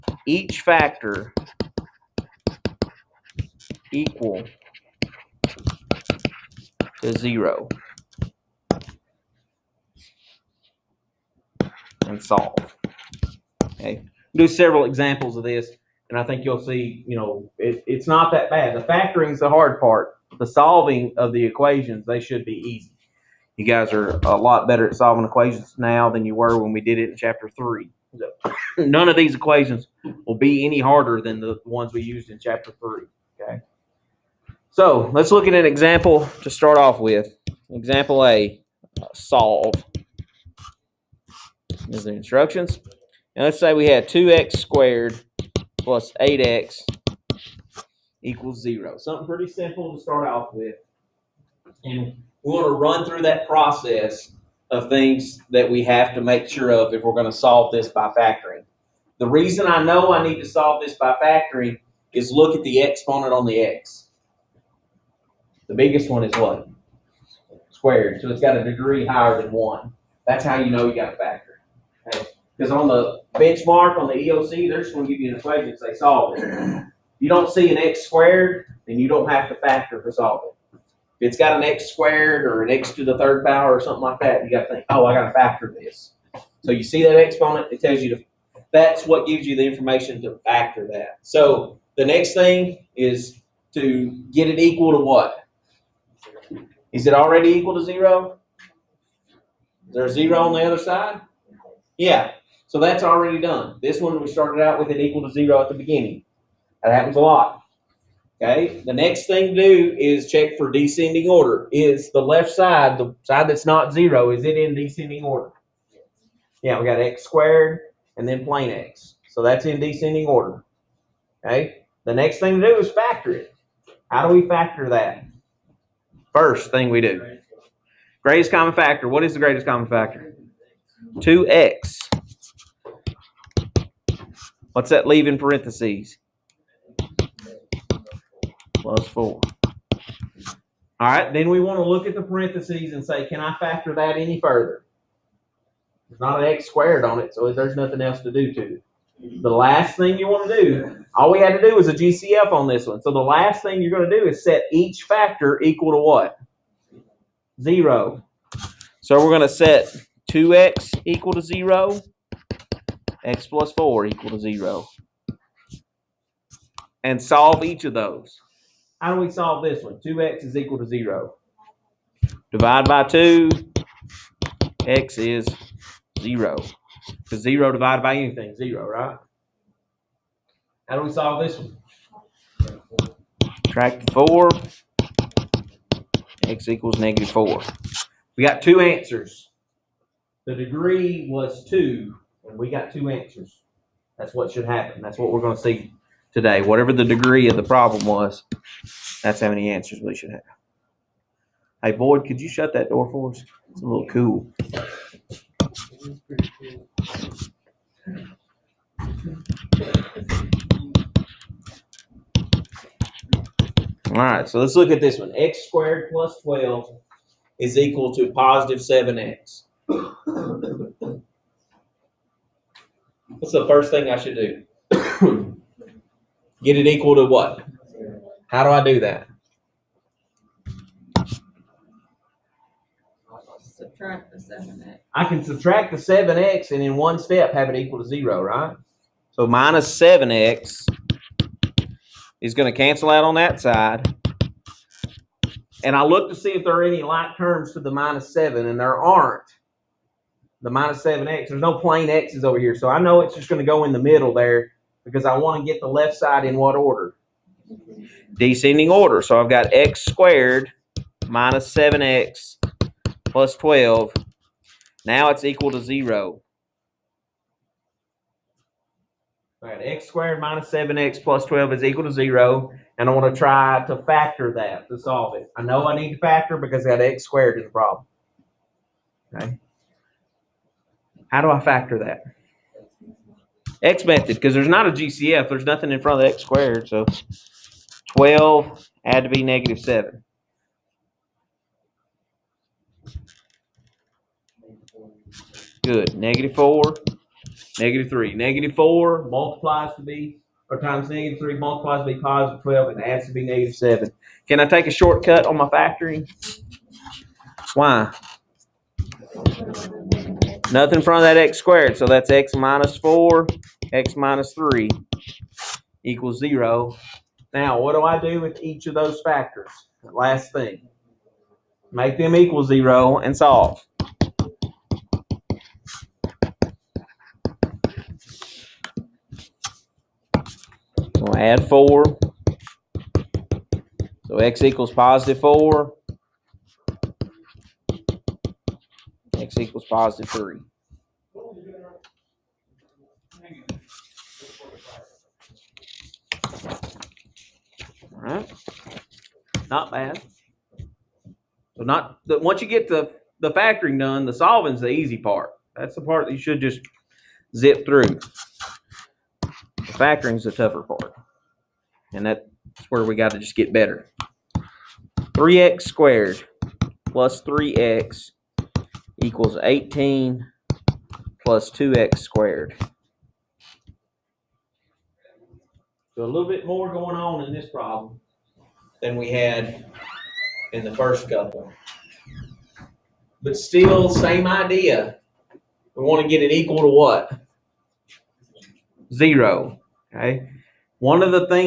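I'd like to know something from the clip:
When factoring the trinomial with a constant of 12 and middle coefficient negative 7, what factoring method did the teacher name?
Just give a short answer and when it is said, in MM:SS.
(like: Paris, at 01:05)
X method, at 04:43.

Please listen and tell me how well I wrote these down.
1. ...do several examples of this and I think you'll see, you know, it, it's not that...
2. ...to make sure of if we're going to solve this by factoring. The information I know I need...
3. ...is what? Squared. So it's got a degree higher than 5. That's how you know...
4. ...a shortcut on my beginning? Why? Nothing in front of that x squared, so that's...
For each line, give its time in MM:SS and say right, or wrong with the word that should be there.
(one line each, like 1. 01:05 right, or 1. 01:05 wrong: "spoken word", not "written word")
1. 00:14 right
2. 00:56 wrong: "reason", not "information"
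3. 01:06 wrong: "1", not "5"
4. 05:04 wrong: "factoring", not "beginning".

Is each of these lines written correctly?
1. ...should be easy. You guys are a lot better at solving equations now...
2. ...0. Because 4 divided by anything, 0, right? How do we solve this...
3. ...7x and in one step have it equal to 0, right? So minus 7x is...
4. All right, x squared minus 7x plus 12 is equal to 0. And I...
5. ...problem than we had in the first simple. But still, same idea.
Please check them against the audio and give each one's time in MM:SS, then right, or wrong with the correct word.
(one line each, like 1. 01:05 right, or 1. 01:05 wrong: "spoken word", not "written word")
1. 00:22 right
2. 02:56 wrong: "0", not "4"
3. 03:55 right
4. 04:29 right
5. 06:17 wrong: "couple", not "simple".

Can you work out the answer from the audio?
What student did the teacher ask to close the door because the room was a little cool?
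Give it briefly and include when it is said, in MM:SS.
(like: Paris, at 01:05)
Boyd, at 03:21.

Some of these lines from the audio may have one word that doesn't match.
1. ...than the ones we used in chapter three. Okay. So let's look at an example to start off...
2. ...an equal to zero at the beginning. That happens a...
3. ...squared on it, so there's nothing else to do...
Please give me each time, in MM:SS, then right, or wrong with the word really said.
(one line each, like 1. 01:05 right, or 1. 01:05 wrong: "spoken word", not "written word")
1. 00:31 right
2. 01:44 right
3. 02:26 right.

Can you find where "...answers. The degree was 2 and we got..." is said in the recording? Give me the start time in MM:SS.
03:08.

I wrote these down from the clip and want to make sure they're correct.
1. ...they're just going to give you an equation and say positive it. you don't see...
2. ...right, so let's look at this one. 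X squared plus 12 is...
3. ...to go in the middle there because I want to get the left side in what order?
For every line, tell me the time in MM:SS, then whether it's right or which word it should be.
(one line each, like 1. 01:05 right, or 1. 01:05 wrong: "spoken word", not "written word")
1. 01:14 wrong: "solve", not "positive"
2. 03:34 right
3. 04:13 right.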